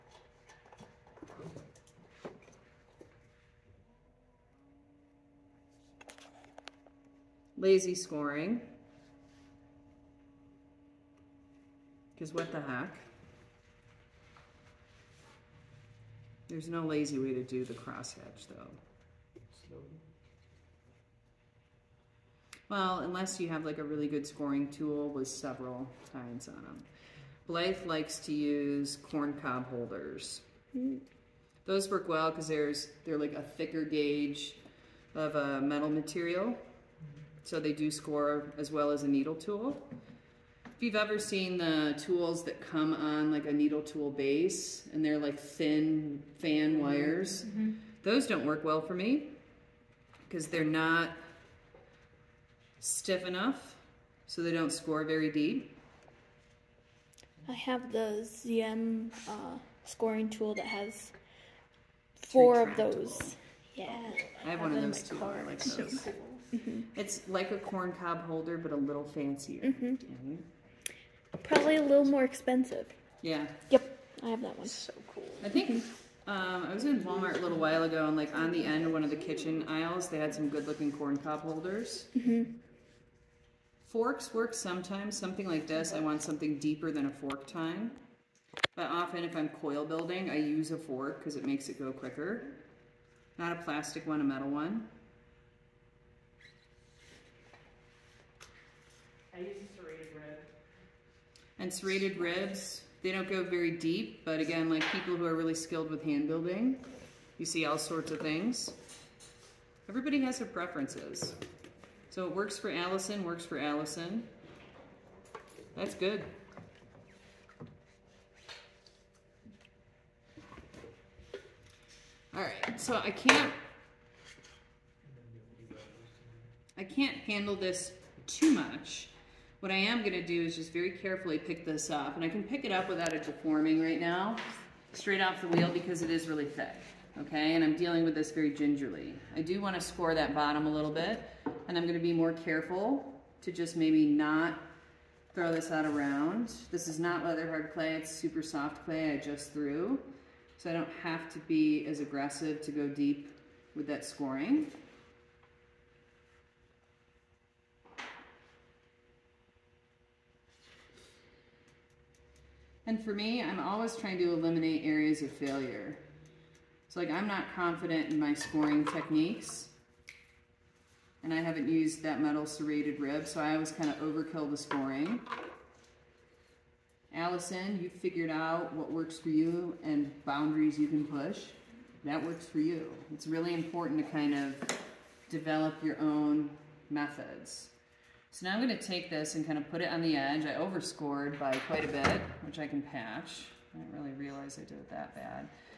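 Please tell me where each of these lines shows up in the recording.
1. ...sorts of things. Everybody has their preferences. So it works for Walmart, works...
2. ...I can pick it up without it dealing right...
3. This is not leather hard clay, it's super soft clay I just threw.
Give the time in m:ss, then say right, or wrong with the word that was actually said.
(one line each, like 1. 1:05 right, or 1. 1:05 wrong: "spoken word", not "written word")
1. 1:47 wrong: "Allison", not "Walmart"
2. 2:12 wrong: "deforming", not "dealing"
3. 2:26 right.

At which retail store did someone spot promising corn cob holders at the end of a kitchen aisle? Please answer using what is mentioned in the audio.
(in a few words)
Walmart.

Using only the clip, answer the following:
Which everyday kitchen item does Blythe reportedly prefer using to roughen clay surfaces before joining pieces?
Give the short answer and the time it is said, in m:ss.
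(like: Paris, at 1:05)
Corncob holders, at 0:29.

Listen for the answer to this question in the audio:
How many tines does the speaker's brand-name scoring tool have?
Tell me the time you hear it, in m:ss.
1:02.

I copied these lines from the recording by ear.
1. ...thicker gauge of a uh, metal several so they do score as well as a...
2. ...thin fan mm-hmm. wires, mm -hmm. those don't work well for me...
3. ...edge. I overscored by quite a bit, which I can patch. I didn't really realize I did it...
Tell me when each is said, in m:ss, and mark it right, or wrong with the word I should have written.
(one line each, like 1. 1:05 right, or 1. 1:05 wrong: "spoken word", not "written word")
1. 0:33 wrong: "material", not "several"
2. 0:45 right
3. 3:10 right.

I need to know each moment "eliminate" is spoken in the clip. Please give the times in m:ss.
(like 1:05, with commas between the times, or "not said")
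2:44.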